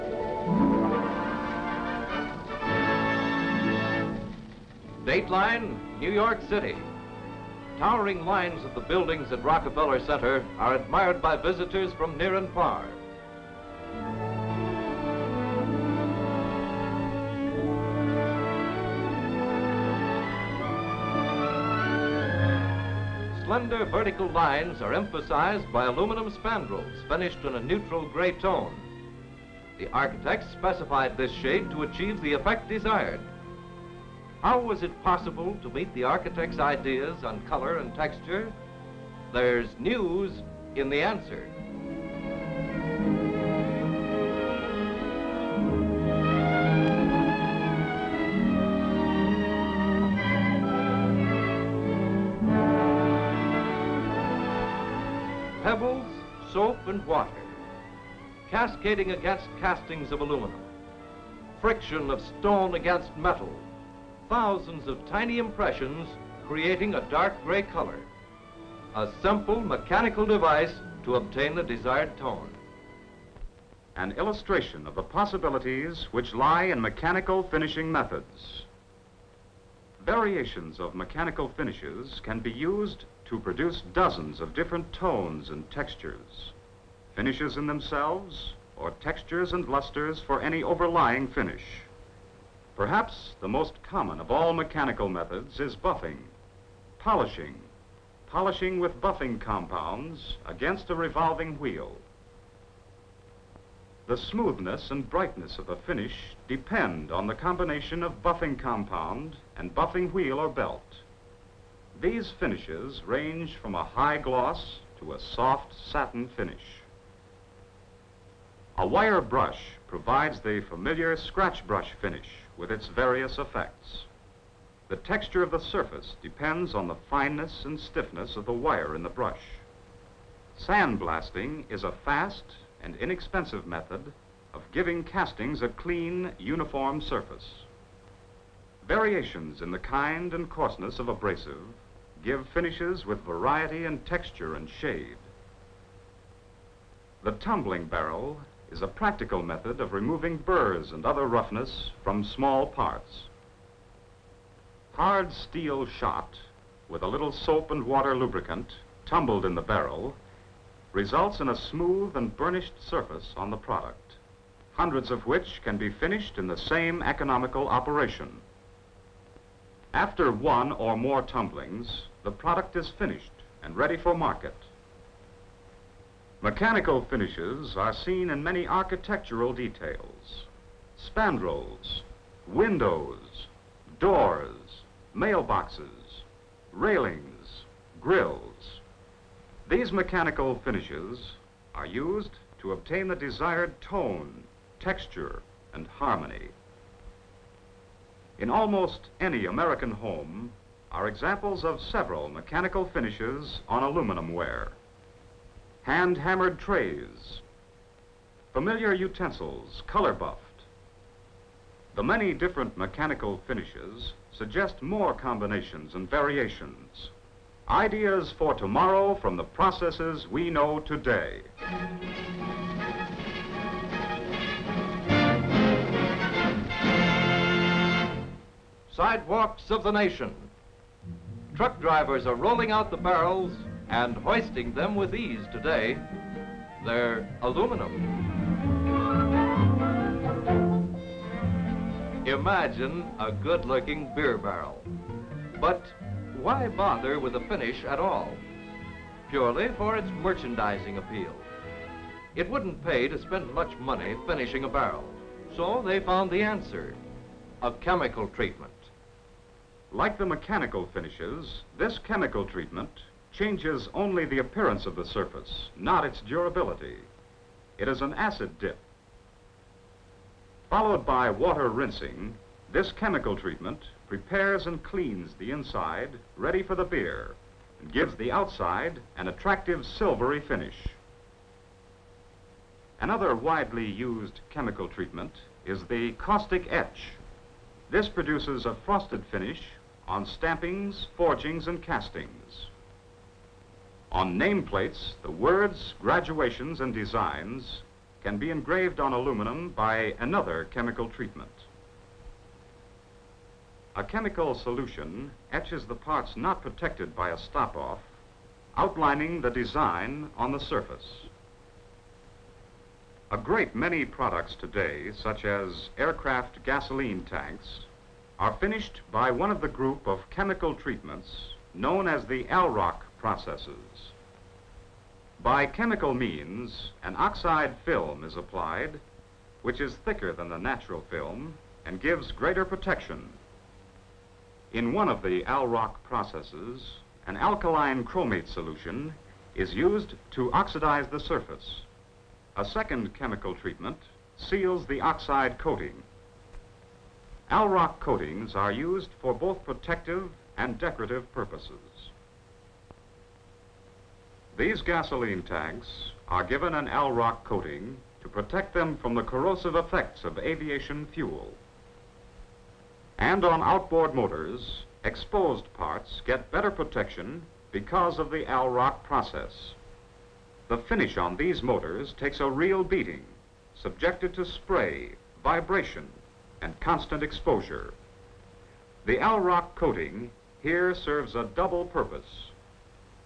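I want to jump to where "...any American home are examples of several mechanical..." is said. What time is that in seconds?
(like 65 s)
199 s.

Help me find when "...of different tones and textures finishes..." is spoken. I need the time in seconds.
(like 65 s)
84 s.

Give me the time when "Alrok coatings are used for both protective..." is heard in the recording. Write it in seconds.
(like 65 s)
347 s.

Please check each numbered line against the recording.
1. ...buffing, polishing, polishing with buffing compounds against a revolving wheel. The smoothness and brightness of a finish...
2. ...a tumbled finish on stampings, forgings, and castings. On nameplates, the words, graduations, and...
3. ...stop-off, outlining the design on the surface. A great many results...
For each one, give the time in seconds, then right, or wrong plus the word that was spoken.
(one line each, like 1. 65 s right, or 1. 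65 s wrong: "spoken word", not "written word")
1. 95 s right
2. 288 s wrong: "frosted", not "tumbled"
3. 307 s wrong: "products", not "results".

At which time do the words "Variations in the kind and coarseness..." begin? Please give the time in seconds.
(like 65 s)
138 s.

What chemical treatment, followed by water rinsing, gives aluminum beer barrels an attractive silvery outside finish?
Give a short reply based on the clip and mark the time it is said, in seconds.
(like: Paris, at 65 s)
An acid dip, at 268 s.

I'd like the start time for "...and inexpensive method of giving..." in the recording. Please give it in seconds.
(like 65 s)
132 s.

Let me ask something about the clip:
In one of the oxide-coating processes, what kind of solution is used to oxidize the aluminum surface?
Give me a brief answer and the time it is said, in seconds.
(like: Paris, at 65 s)
Alkaline chromate solution, at 337 s.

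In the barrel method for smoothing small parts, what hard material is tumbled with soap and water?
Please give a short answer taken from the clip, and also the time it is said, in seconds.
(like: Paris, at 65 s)
Hard steel shot, at 154 s.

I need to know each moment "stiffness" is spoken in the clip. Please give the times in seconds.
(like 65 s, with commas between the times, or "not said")
127 s.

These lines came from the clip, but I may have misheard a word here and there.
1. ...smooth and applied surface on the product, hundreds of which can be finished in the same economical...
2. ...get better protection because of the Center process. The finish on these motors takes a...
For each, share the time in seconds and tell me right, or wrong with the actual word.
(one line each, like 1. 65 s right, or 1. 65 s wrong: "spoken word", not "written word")
1. 161 s wrong: "burnished", not "applied"
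2. 366 s wrong: "Alrok", not "Center".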